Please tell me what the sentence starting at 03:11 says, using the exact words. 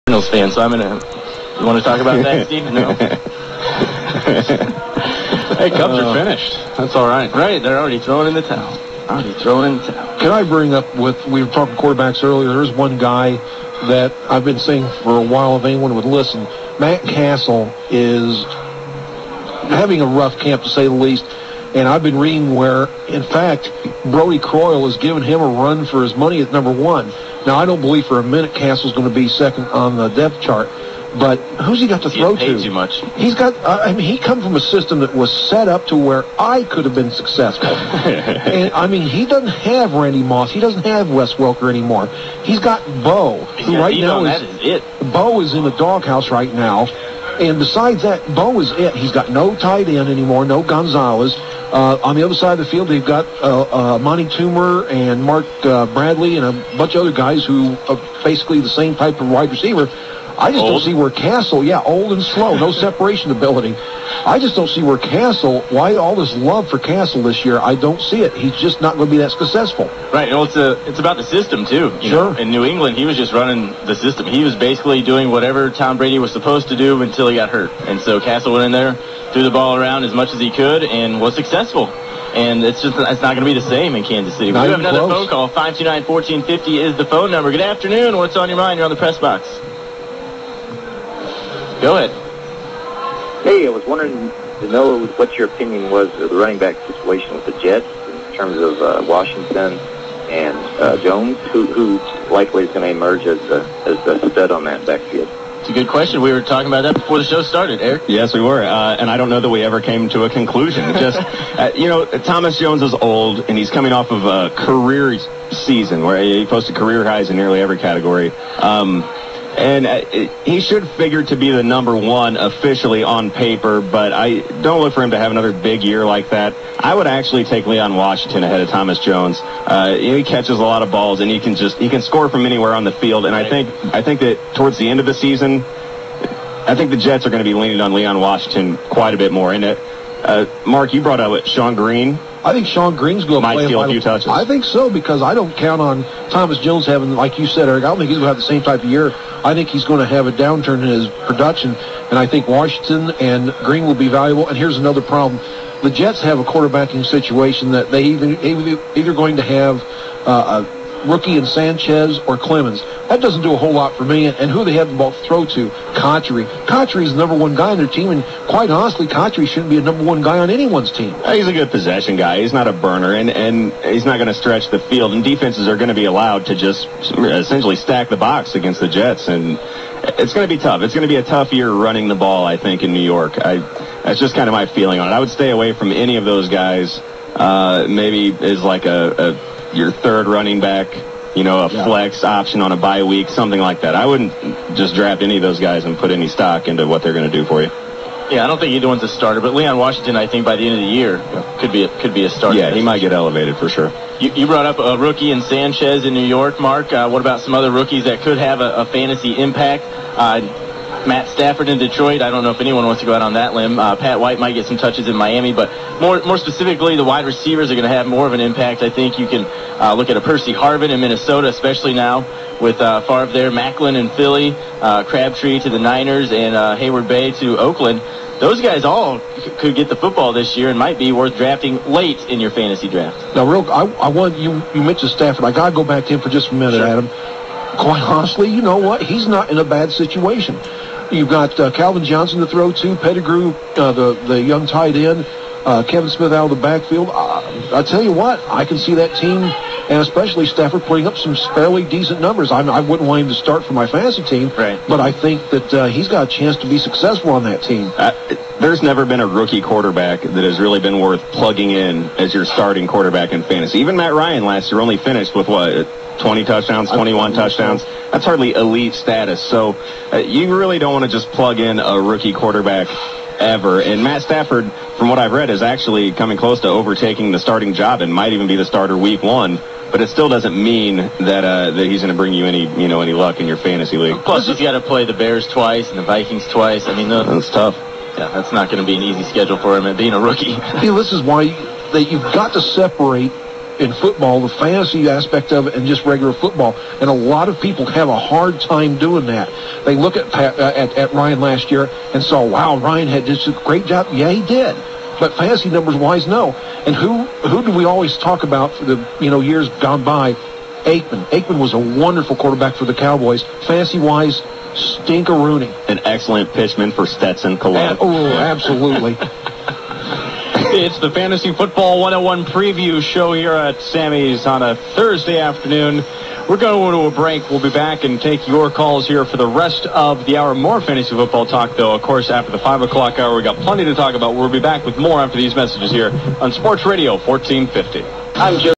flex option on a bye week, something like that.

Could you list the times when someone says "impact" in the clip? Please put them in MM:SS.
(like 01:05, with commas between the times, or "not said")
03:29, 03:38.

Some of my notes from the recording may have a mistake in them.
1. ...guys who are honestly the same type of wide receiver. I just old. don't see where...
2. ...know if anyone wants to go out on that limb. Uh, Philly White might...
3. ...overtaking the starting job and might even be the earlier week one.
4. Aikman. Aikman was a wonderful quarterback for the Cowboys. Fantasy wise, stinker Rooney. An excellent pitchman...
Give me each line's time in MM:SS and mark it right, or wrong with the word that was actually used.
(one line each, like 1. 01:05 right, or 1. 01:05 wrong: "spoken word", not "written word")
1. 00:57 wrong: "basically", not "honestly"
2. 03:32 wrong: "Pat", not "Philly"
3. 04:36 wrong: "starter", not "earlier"
4. 05:10 right.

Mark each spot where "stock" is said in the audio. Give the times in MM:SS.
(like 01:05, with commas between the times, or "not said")
03:16.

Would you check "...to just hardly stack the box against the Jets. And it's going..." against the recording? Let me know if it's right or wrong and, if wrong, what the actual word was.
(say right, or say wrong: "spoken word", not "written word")
wrong: "essentially", not "hardly".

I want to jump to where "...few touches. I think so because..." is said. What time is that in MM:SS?
02:23.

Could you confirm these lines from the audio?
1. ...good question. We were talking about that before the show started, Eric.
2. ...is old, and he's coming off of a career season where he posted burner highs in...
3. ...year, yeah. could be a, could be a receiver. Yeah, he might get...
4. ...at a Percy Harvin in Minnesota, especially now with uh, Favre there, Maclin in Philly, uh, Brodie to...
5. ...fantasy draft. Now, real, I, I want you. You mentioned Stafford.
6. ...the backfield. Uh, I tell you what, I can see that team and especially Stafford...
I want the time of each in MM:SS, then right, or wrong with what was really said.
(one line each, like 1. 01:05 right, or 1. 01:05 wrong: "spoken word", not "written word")
1. 01:45 right
2. 01:52 wrong: "career", not "burner"
3. 03:20 wrong: "starter", not "receiver"
4. 03:40 wrong: "Crabtree", not "Brodie"
5. 03:52 right
6. 04:06 right.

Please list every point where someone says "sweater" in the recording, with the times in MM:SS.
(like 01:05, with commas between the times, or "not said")
not said.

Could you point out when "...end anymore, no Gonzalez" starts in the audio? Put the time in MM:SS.
00:49.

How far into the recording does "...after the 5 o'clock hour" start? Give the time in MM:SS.
05:32.